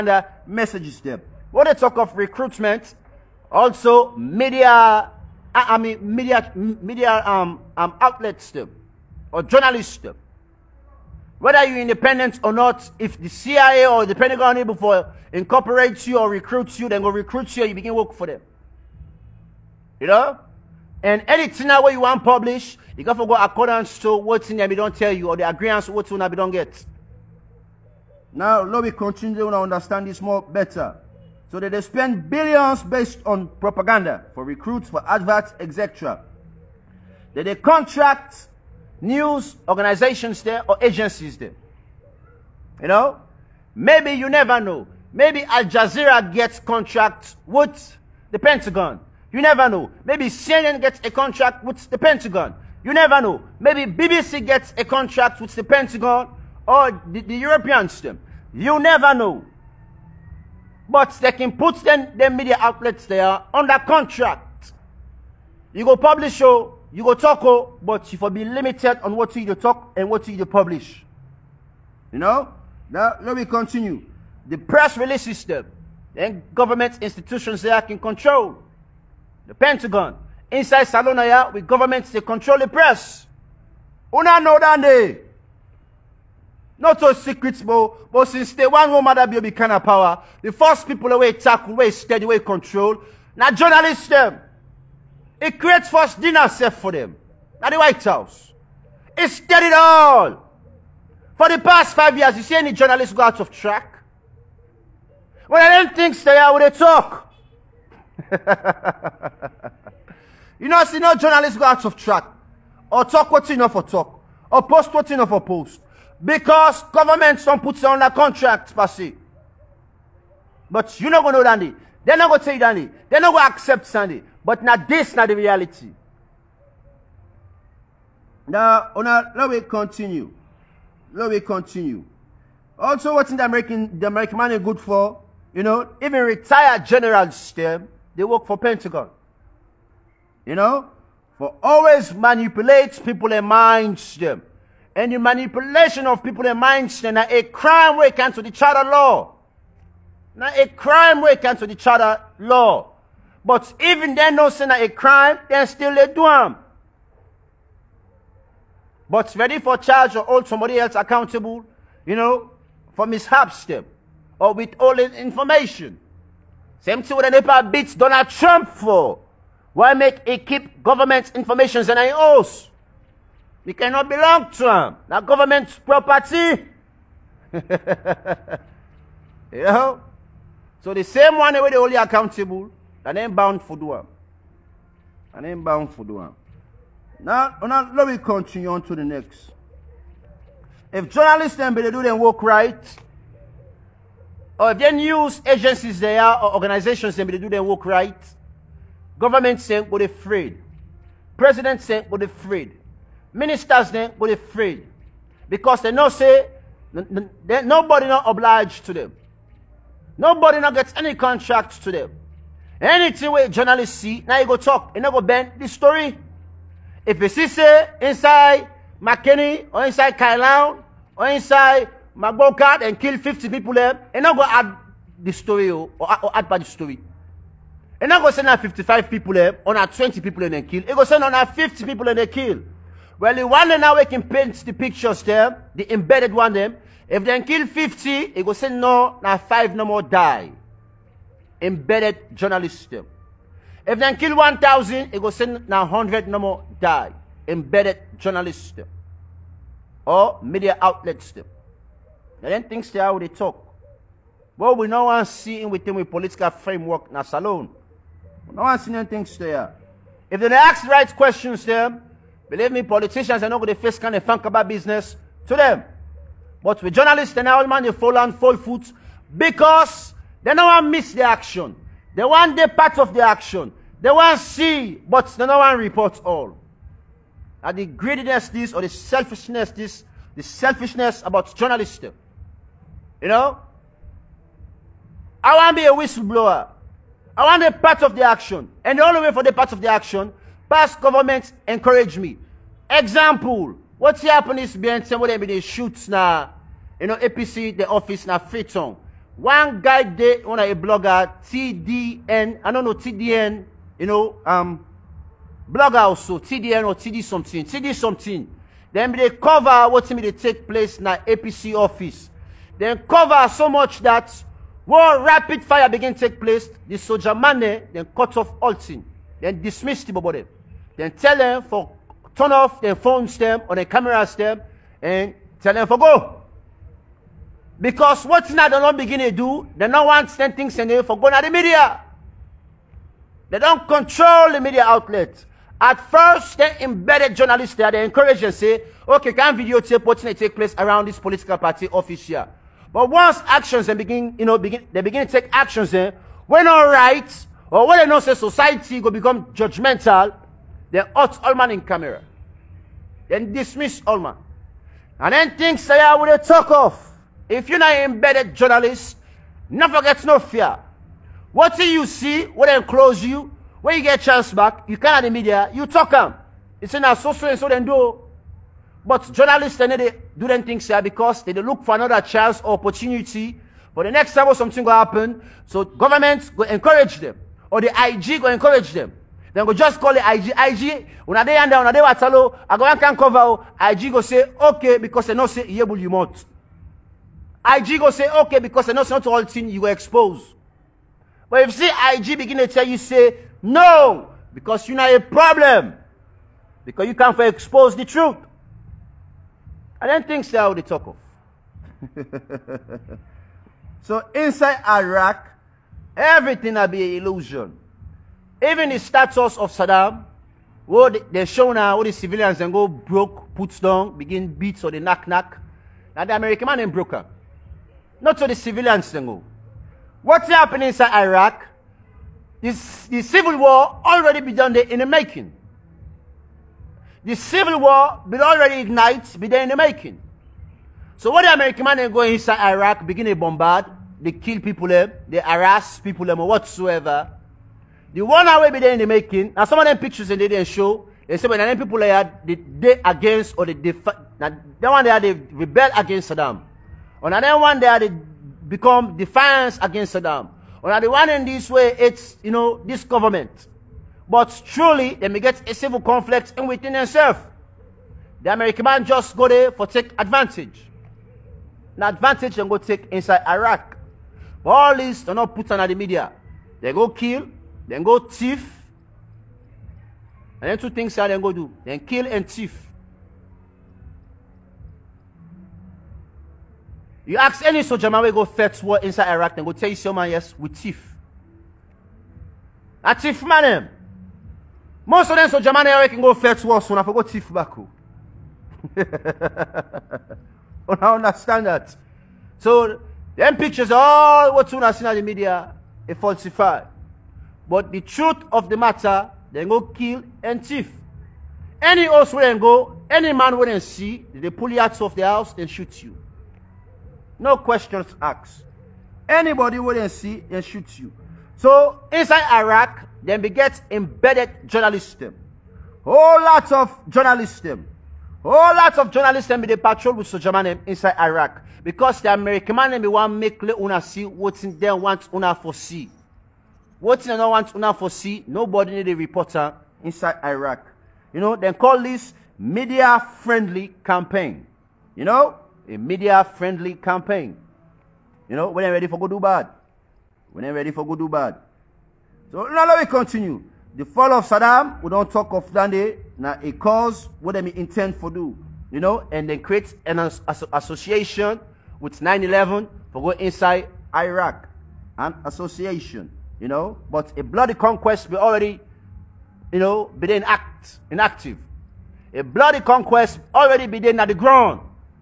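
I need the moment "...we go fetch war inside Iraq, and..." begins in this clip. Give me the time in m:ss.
7:58.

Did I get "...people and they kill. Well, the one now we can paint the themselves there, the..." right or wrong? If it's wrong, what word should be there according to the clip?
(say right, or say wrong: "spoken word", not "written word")
wrong: "pictures", not "themselves".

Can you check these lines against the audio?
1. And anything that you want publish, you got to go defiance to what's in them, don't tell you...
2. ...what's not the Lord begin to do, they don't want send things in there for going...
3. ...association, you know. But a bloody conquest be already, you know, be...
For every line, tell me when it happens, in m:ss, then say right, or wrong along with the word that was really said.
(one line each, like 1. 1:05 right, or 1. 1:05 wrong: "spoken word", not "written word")
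1. 0:21 wrong: "accordance", not "defiance"
2. 5:28 right
3. 9:15 right.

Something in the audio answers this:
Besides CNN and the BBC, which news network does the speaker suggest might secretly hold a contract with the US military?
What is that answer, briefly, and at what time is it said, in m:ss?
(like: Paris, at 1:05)
Al Jazeera, at 0:45.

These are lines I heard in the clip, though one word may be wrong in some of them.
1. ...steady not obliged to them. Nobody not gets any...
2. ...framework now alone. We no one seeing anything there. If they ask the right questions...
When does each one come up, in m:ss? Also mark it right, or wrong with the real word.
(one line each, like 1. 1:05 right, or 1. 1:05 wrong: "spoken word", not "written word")
1. 3:26 wrong: "nobody", not "steady"
2. 4:16 right.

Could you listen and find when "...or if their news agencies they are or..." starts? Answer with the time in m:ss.
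3:14.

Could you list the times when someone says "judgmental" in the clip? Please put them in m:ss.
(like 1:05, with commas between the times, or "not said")
5:49.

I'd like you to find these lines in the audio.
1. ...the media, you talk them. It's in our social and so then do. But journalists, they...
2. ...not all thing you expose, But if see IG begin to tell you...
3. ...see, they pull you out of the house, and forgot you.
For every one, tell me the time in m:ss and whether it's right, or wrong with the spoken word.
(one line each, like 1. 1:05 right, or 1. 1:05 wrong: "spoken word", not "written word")
1. 6:05 right
2. 6:29 right
3. 8:23 wrong: "shoot", not "forgot".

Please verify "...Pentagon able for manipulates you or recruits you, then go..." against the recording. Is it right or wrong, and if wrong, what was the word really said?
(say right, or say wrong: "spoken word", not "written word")
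wrong: "incorporates", not "manipulates".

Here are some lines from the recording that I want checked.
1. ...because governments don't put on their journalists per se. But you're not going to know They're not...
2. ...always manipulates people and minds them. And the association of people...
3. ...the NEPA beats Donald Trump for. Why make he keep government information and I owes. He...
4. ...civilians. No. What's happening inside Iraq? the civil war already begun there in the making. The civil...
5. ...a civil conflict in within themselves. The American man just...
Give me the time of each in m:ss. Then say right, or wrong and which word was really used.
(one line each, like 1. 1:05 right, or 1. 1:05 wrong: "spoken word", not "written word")
1. 1:56 wrong: "contracts", not "journalists"
2. 2:21 wrong: "manipulation", not "association"
3. 2:47 right
4. 6:58 right
5. 7:35 right.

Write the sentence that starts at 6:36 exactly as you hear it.
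Because you can't expose the truth.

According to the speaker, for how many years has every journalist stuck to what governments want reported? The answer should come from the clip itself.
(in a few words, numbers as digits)
5.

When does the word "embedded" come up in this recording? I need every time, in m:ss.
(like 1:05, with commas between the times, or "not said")
3:55, 4:01, 4:07, 5:36, 5:57, 8:33.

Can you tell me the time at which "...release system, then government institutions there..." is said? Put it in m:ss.
1:14.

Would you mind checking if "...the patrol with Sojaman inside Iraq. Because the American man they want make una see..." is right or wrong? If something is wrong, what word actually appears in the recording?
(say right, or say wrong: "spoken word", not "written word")
right.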